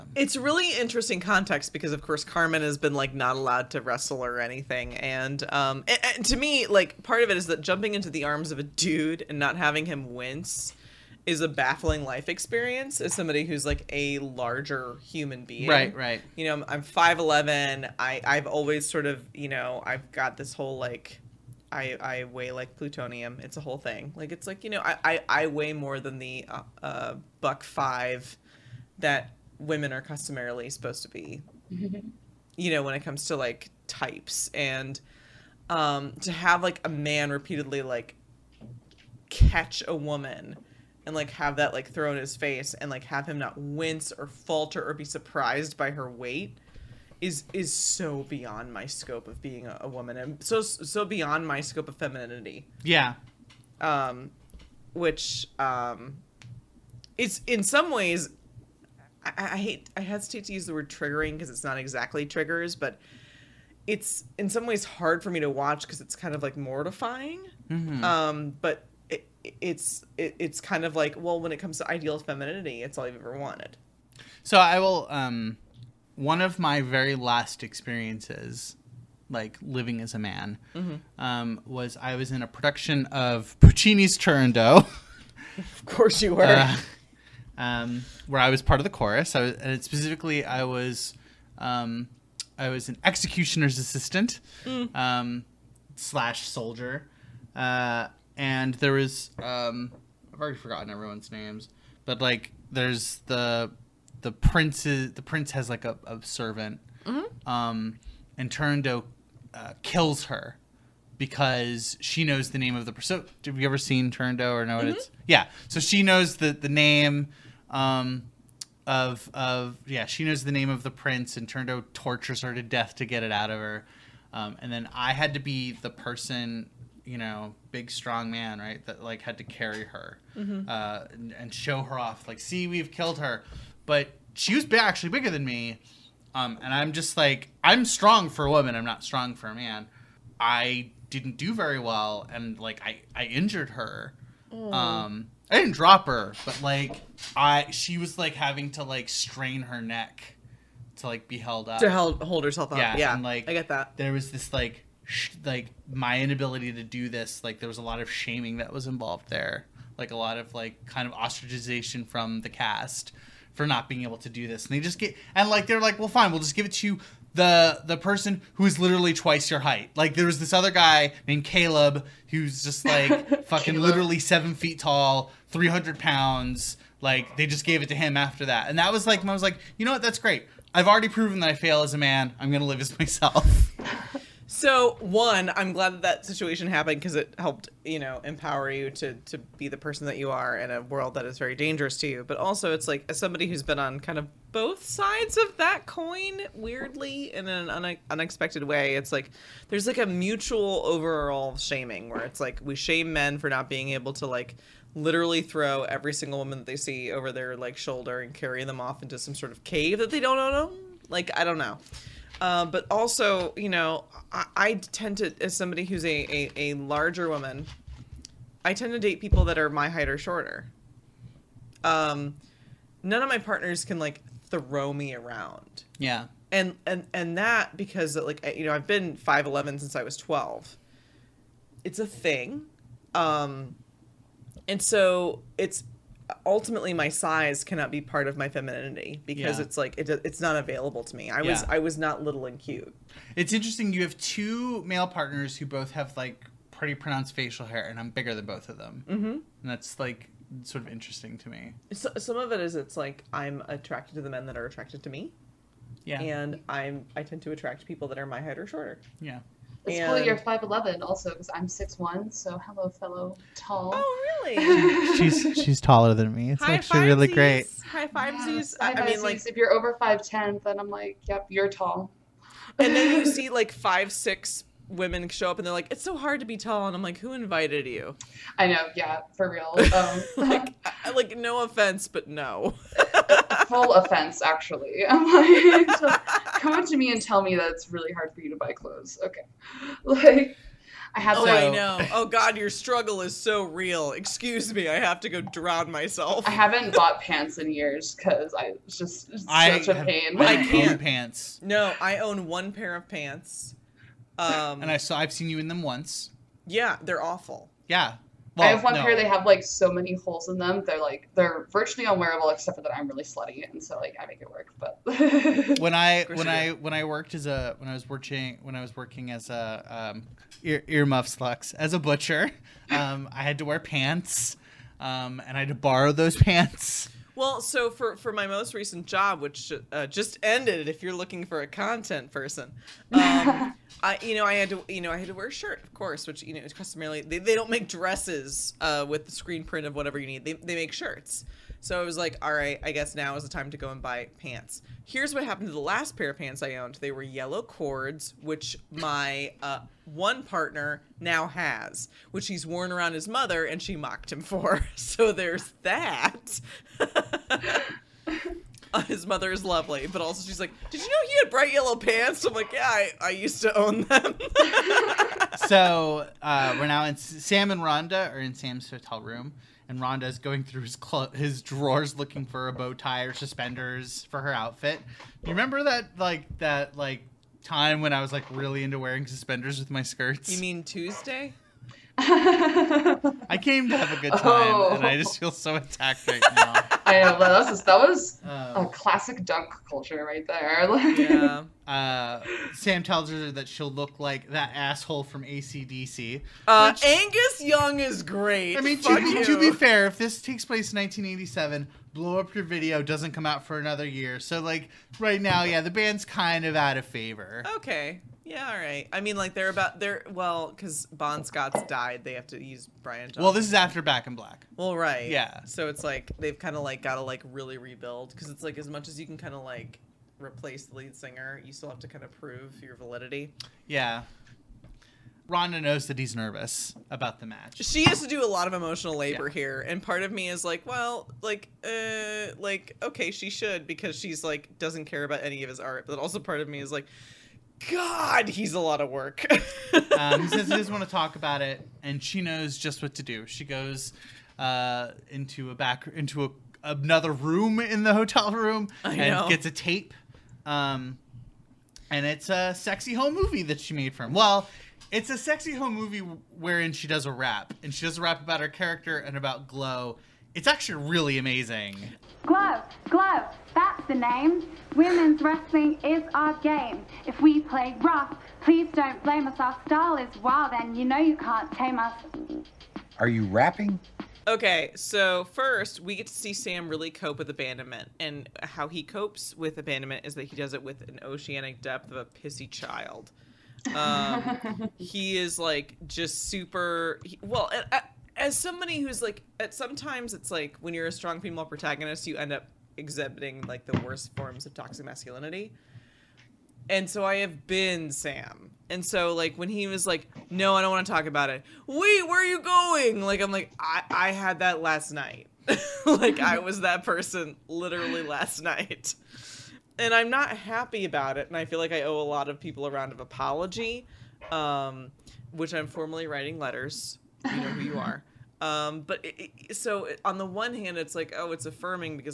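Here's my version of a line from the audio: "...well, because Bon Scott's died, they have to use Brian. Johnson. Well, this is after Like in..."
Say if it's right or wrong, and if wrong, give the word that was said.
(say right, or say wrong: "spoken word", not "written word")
wrong: "Back", not "Like".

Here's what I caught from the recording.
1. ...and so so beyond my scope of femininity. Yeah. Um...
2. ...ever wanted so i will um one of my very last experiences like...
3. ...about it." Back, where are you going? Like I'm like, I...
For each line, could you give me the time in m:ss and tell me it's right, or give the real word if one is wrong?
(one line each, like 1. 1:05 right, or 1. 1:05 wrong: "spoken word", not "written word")
1. 0:50 right
2. 1:13 right
3. 8:21 wrong: "Wait", not "Back".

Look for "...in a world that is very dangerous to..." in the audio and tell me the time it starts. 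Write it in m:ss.
3:10.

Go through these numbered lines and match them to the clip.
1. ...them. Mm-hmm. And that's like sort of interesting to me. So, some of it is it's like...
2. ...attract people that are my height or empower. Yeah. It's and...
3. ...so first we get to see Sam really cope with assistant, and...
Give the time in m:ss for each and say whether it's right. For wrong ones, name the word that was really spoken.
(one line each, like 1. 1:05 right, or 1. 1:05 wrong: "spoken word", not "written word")
1. 4:08 right
2. 4:17 wrong: "shorter", not "empower"
3. 7:54 wrong: "abandonment", not "assistant".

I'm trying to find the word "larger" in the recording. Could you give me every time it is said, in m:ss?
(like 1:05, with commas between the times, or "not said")
0:14, 3:36.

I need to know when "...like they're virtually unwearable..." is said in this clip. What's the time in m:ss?
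5:11.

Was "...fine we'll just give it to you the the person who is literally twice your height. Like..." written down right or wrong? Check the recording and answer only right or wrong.
right.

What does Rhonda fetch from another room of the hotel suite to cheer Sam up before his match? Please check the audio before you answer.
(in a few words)
A tape.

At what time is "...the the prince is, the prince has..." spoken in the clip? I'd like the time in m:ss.
1:43.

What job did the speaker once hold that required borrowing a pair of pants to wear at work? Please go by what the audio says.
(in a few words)
Butcher.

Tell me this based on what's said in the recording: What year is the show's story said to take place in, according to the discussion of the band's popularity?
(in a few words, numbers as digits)
1987.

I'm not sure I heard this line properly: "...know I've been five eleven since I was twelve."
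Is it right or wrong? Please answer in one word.
right.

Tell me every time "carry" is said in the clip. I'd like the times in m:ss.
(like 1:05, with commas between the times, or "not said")
2:09, 3:28.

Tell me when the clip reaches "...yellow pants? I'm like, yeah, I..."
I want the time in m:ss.
6:01.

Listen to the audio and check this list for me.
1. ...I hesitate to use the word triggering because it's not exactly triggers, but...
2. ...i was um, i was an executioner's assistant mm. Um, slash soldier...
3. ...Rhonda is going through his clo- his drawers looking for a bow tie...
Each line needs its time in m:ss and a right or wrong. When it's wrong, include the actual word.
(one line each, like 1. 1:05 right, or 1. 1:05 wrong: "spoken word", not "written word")
1. 0:59 right
2. 1:30 right
3. 6:09 right.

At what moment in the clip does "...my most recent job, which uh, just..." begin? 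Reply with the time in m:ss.
5:28.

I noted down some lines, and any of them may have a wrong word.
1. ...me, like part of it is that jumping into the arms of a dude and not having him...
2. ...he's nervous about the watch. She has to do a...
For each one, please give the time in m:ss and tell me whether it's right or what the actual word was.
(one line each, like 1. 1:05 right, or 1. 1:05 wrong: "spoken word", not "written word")
1. 0:06 right
2. 7:06 wrong: "match", not "watch".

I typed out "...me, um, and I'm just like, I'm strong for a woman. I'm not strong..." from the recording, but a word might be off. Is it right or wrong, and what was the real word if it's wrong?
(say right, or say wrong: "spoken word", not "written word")
right.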